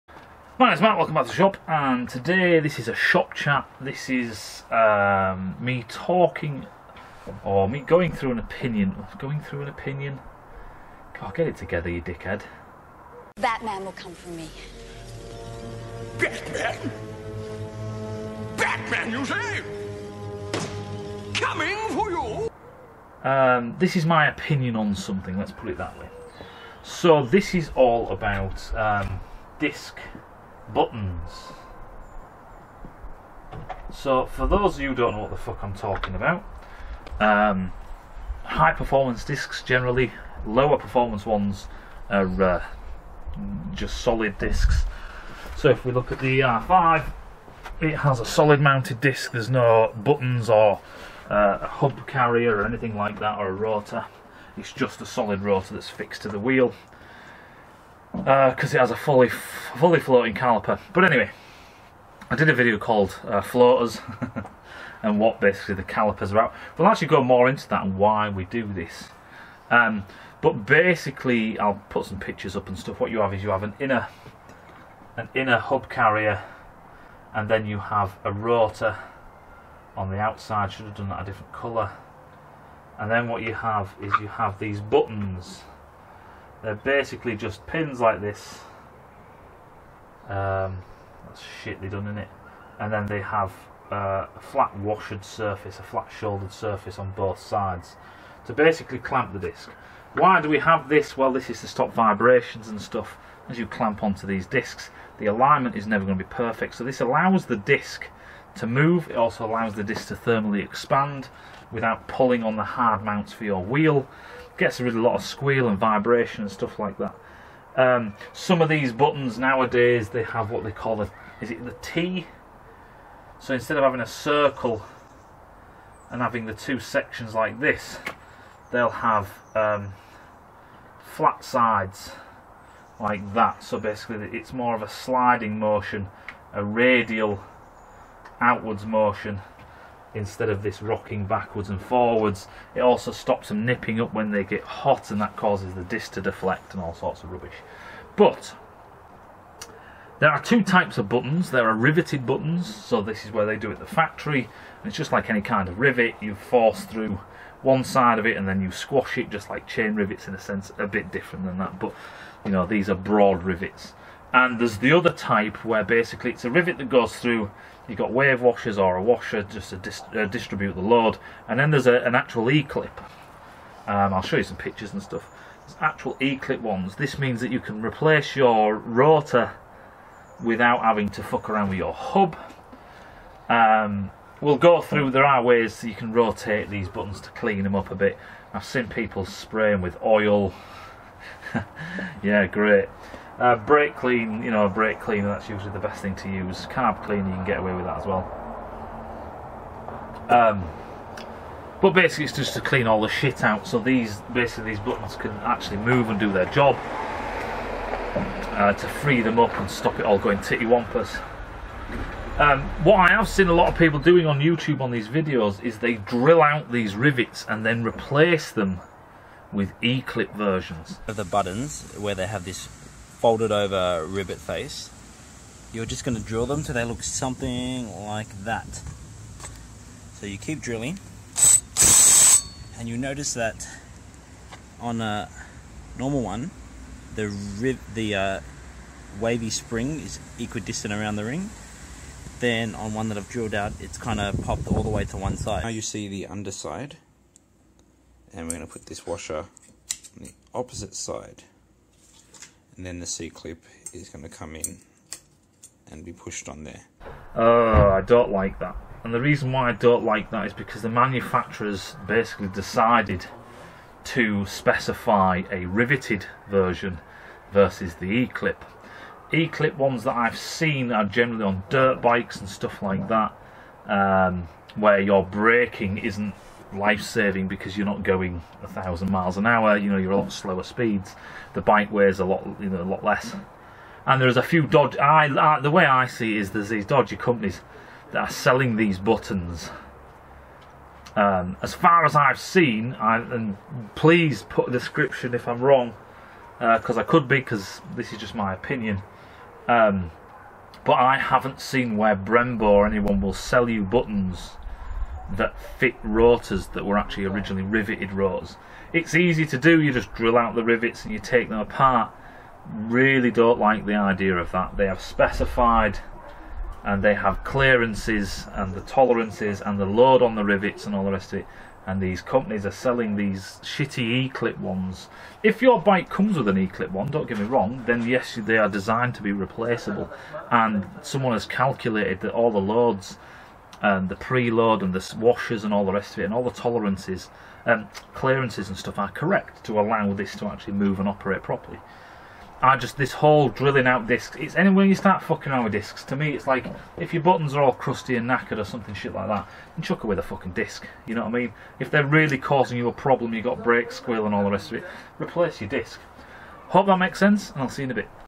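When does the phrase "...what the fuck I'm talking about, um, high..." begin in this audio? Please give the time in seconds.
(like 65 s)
35 s.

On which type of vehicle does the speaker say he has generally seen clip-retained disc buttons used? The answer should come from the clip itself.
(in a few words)
Dirt bikes.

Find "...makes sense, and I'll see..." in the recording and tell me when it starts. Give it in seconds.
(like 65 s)
356 s.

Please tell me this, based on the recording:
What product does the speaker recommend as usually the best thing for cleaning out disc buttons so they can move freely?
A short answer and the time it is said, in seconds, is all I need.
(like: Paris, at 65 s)
Brake cleaner, at 194 s.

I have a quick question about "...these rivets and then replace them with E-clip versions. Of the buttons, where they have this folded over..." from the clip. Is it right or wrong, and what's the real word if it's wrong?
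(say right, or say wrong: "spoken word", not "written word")
right.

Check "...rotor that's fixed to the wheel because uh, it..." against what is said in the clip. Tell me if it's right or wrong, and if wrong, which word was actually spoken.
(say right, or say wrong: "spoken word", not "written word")
right.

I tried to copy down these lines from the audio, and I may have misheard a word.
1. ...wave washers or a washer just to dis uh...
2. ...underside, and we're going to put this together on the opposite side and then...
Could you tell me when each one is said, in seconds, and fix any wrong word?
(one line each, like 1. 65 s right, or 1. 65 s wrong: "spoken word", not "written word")
1. 168 s right
2. 246 s wrong: "washer", not "together".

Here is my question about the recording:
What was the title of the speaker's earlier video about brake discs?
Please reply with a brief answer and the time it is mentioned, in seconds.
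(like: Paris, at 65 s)
Floaters, at 63 s.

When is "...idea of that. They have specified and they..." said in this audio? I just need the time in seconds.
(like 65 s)
313 s.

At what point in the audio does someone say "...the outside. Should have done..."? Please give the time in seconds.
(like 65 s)
80 s.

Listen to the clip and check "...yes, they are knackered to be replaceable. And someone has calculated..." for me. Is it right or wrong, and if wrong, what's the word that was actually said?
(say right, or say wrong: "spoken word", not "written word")
wrong: "designed", not "knackered".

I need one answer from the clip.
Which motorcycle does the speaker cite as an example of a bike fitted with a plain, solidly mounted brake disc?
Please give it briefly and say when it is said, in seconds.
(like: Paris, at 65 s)
R5, at 46 s.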